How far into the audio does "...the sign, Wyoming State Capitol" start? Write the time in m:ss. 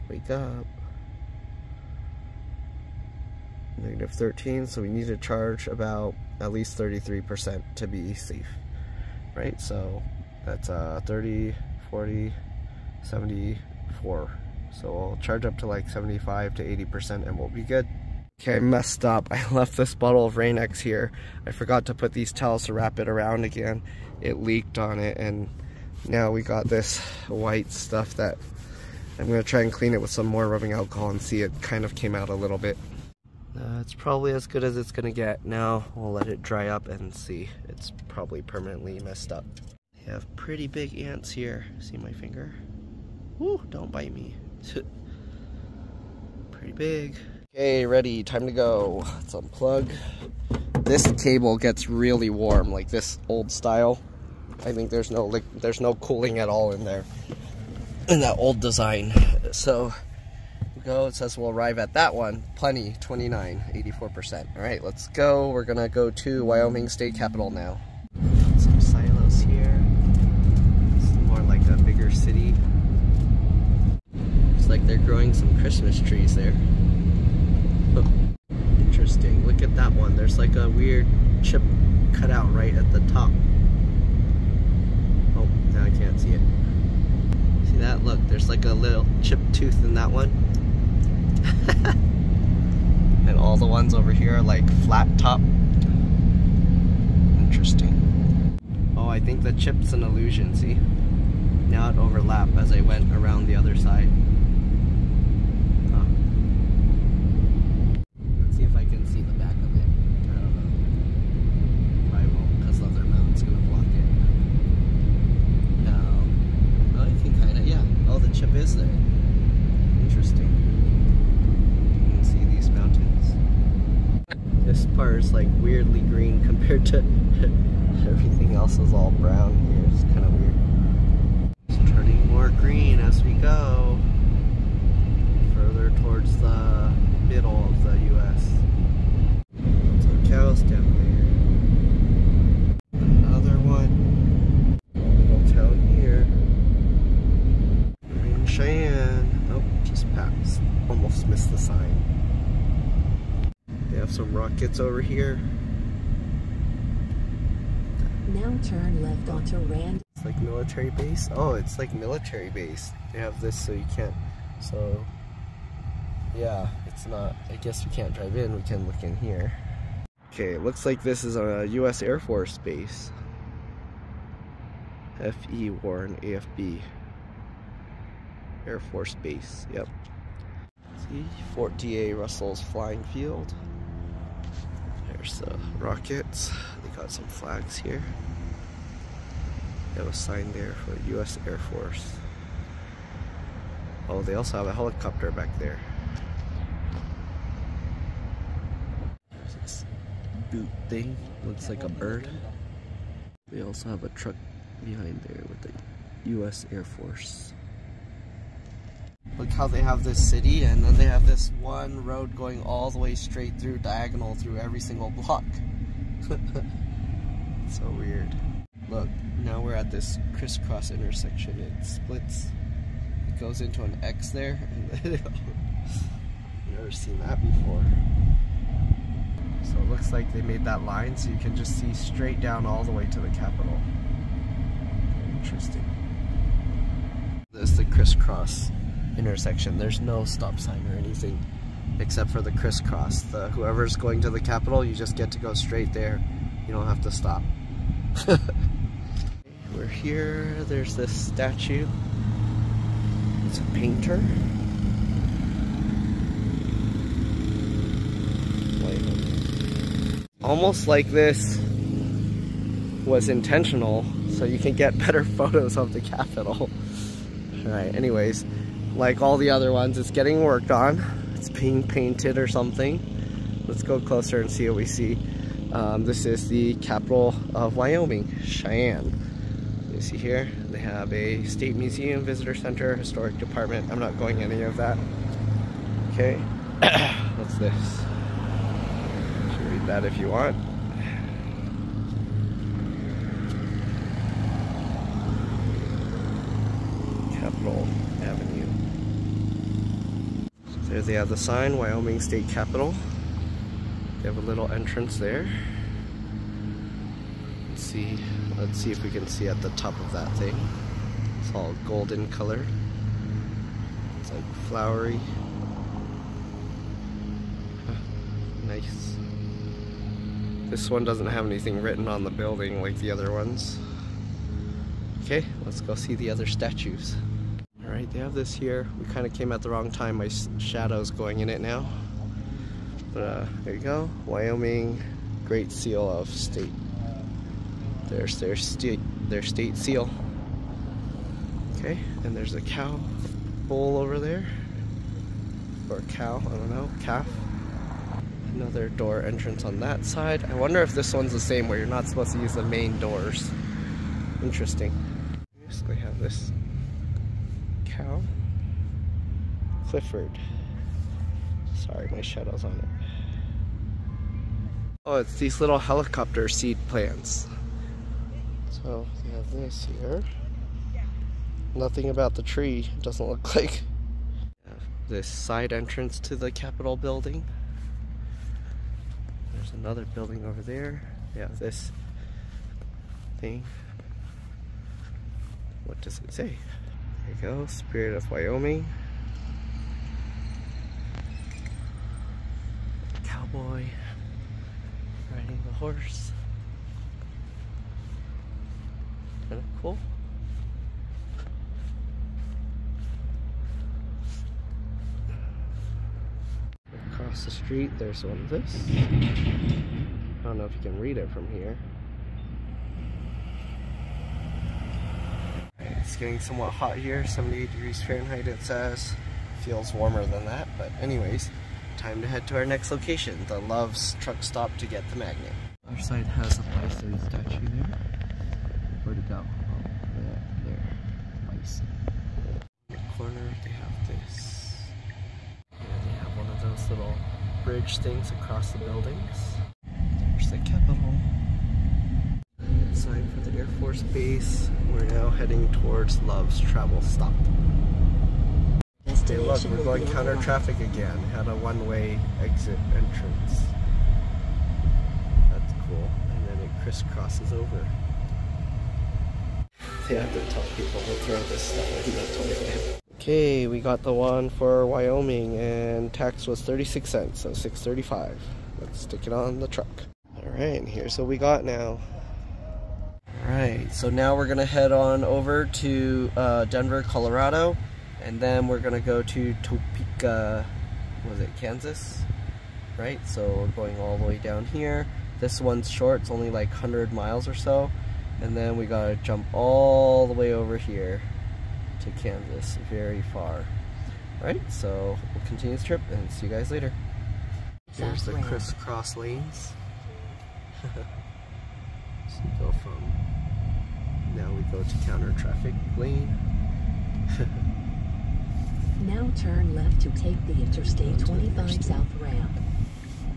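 5:01.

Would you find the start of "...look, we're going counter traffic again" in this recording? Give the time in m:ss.
7:29.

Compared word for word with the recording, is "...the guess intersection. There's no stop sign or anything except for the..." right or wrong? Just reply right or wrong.
wrong.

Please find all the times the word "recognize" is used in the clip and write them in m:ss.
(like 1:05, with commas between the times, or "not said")
not said.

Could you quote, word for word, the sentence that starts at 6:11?
Nothing about the tree, it doesn't look like.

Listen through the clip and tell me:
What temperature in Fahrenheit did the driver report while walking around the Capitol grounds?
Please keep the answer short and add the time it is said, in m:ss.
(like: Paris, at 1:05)
78 degrees, at 6:57.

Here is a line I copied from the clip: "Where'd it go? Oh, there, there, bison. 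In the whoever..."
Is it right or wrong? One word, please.
wrong.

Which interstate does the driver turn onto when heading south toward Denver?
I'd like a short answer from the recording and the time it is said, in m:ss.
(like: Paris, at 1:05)
Interstate 25, at 8:30.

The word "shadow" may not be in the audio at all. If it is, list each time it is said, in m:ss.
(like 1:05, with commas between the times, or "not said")
5:30, 6:02.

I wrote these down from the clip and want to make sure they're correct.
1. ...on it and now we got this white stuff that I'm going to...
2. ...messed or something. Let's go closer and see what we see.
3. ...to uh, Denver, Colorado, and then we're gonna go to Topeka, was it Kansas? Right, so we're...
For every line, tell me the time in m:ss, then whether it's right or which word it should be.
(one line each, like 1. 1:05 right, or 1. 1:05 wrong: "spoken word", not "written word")
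1. 0:24 right
2. 4:31 wrong: "painted", not "messed"
3. 7:55 right.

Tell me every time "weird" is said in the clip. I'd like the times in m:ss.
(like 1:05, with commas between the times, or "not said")
1:20, 3:37.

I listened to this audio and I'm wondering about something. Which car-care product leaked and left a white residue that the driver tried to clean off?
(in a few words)
Rain-X.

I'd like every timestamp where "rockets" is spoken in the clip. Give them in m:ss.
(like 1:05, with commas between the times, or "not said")
2:34, 3:05.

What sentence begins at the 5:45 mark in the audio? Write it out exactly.
Or cow, I don't know, calf.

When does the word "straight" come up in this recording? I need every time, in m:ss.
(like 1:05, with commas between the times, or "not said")
3:33, 3:51, 4:05.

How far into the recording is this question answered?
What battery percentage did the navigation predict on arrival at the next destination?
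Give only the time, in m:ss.
1:03.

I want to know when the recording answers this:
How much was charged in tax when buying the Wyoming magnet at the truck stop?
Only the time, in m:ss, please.
7:46.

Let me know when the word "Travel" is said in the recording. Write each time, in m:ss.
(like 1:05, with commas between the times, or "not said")
7:26.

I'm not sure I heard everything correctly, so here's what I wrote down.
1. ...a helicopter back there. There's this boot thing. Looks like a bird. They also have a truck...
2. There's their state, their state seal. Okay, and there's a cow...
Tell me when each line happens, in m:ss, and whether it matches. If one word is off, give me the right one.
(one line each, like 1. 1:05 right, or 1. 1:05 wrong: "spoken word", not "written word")
1. 3:14 right
2. 5:38 right.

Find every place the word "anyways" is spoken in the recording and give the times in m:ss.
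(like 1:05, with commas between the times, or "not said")
4:27, 7:01.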